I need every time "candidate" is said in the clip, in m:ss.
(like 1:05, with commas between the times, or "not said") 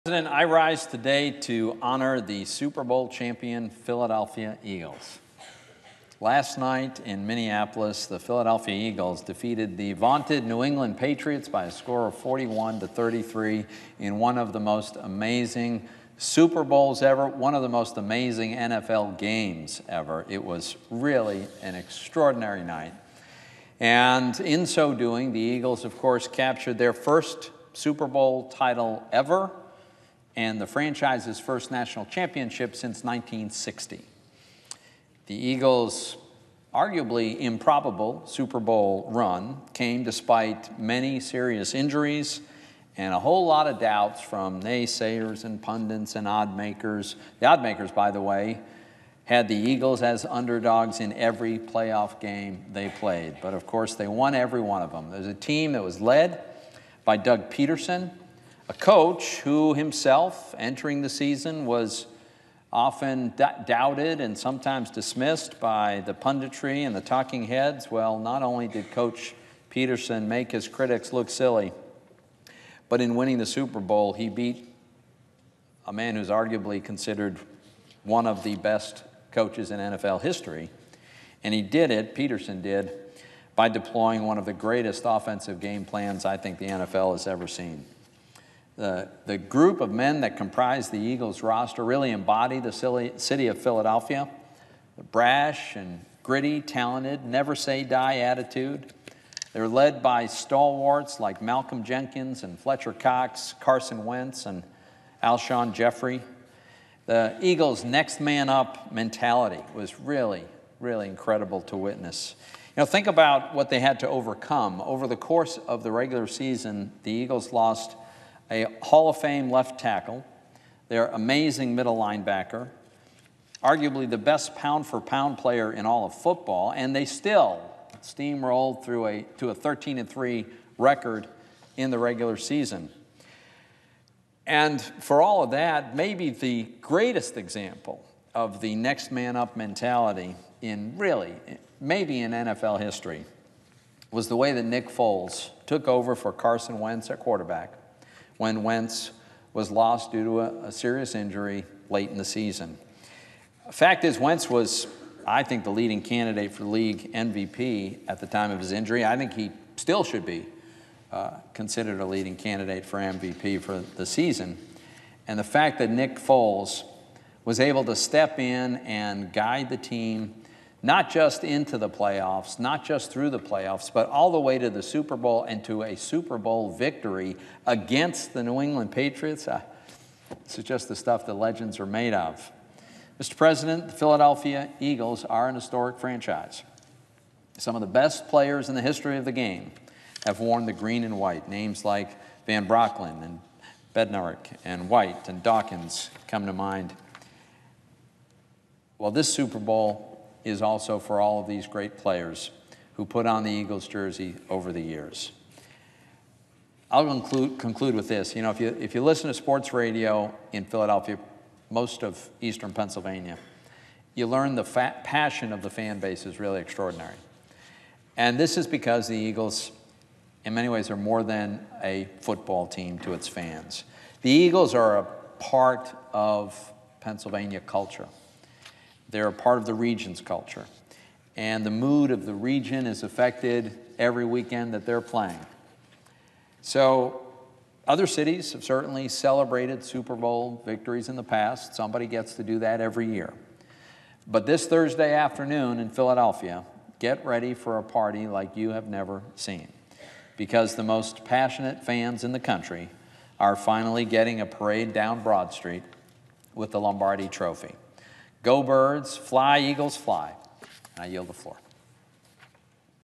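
2:36, 2:42.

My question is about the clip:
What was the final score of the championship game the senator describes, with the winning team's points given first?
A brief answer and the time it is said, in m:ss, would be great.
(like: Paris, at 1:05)
41 to 33, at 0:12.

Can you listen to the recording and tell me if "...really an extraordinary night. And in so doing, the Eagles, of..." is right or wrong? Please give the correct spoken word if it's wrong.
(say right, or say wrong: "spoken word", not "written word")
right.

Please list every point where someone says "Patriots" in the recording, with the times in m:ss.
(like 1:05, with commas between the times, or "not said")
0:10, 2:58.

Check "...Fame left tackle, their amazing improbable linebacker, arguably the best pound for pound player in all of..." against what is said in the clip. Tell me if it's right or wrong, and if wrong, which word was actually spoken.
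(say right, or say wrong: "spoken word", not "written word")
wrong: "middle", not "improbable".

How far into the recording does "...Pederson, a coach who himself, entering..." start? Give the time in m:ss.
0:57.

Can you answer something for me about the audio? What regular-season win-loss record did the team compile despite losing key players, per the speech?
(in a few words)
13 and 3.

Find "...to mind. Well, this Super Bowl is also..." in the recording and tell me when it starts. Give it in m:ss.
3:16.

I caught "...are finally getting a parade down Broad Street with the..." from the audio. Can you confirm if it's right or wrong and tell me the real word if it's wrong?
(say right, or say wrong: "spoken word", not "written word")
right.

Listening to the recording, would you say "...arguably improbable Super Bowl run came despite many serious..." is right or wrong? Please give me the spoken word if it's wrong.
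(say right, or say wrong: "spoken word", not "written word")
right.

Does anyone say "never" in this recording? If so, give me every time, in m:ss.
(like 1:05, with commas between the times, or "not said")
1:37, 4:08.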